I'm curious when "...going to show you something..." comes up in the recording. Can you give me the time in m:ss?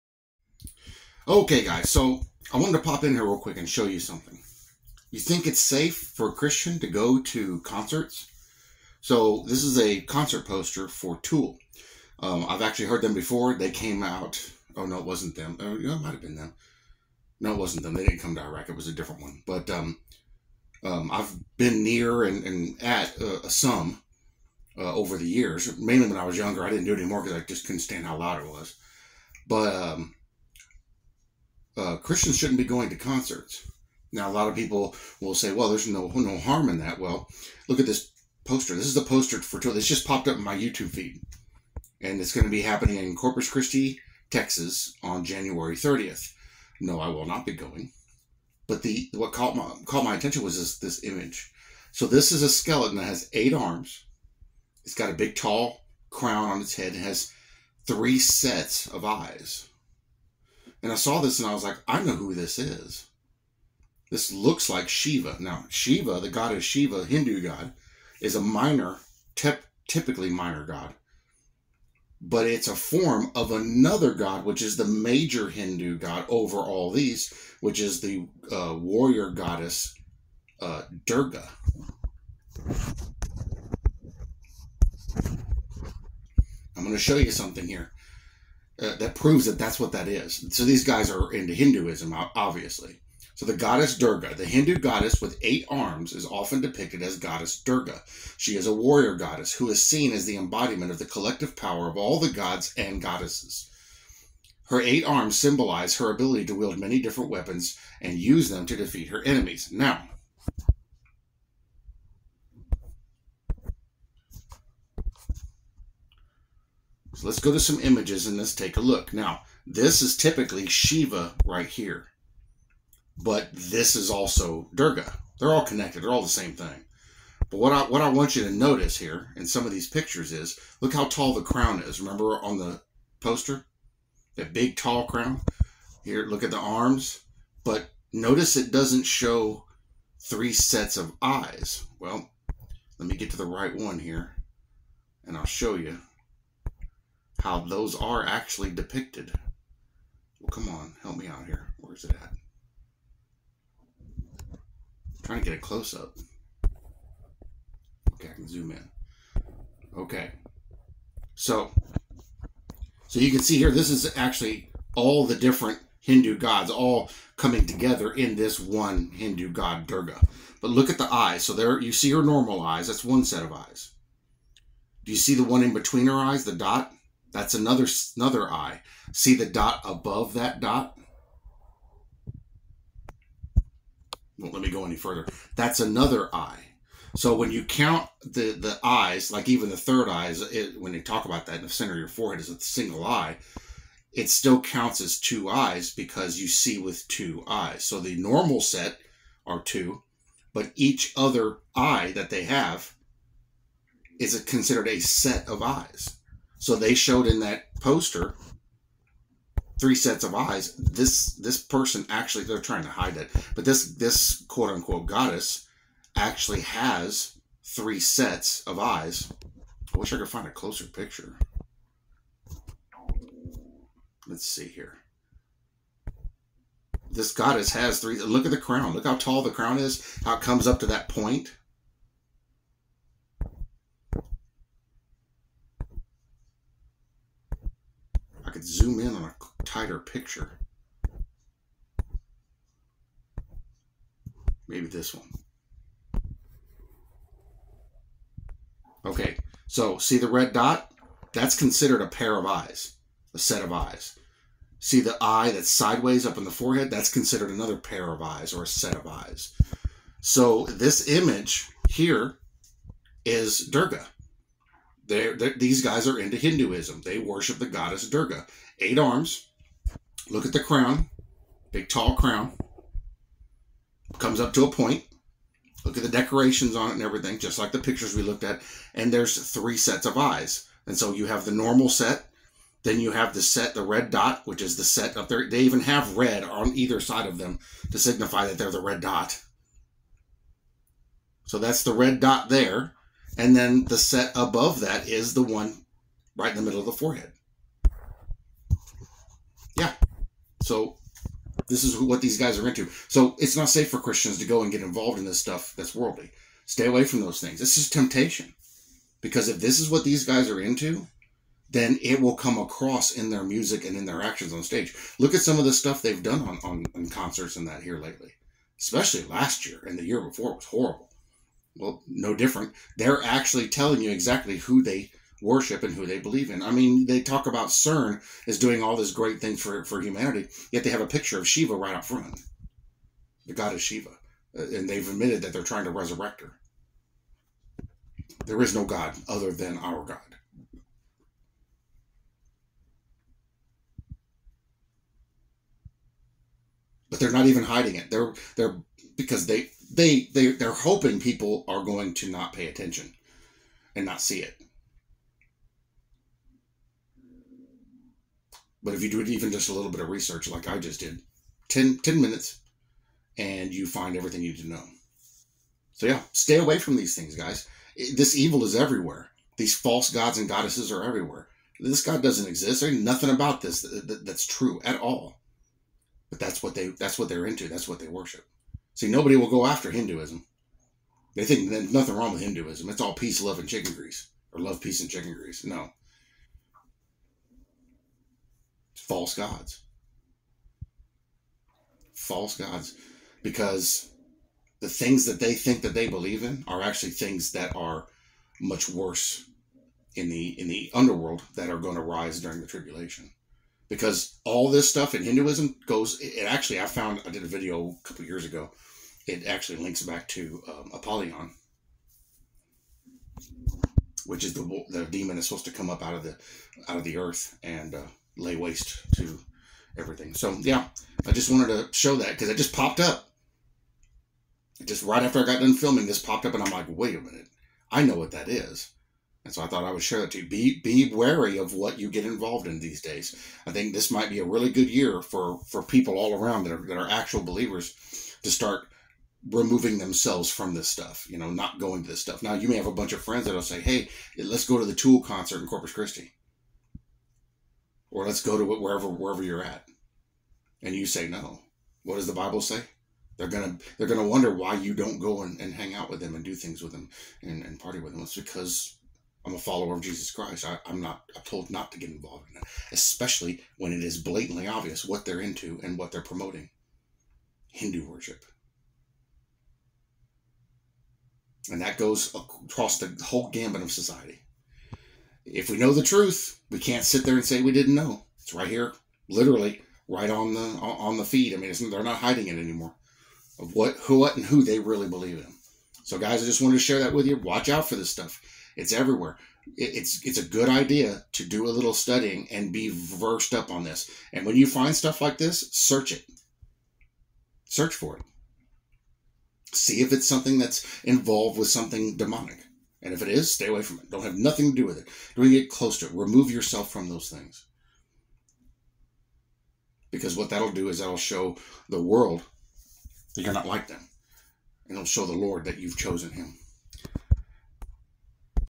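1:26.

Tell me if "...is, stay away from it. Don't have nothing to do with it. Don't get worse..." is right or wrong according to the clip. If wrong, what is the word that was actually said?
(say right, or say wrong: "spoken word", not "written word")
wrong: "close", not "worse".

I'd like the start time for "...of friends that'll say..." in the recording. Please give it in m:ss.
7:23.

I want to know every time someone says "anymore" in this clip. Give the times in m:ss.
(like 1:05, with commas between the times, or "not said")
0:26, 8:02.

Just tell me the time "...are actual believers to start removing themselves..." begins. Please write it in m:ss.
7:16.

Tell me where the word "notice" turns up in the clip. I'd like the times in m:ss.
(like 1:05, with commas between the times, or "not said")
2:08, 2:18.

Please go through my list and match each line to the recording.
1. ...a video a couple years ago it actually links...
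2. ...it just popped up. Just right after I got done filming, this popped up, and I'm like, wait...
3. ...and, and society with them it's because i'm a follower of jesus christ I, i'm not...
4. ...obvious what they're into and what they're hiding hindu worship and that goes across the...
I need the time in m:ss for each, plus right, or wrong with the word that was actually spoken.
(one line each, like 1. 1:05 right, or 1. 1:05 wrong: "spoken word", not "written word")
1. 6:47 right
2. 7:02 right
3. 7:37 wrong: "party", not "society"
4. 7:44 wrong: "promoting", not "hiding".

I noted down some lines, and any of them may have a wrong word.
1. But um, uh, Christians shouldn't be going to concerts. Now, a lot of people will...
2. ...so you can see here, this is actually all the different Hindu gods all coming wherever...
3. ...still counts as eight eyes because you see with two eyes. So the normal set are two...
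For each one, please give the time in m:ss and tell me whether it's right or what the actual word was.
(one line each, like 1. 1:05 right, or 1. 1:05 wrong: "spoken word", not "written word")
1. 0:29 right
2. 2:43 wrong: "together", not "wherever"
3. 3:14 wrong: "two", not "eight".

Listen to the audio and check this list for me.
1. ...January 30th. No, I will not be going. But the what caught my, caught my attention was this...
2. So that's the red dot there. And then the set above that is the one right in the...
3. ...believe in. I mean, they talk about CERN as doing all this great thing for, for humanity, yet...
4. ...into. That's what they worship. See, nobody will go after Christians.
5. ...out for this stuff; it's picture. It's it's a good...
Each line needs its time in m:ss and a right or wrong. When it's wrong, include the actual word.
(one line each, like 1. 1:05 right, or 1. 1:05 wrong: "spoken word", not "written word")
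1. 0:45 right
2. 4:51 right
3. 5:26 right
4. 6:17 wrong: "Hinduism", not "Christians"
5. 8:07 wrong: "everywhere", not "picture".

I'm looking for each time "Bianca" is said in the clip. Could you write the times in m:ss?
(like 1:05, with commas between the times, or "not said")
not said.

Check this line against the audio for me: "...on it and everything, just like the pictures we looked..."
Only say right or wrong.
right.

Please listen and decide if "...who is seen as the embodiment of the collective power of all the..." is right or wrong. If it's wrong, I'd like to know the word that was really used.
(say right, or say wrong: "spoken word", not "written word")
right.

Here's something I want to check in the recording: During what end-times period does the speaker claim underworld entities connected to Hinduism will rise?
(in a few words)
The tribulation.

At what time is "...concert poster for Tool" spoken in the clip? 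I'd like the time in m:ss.
0:10.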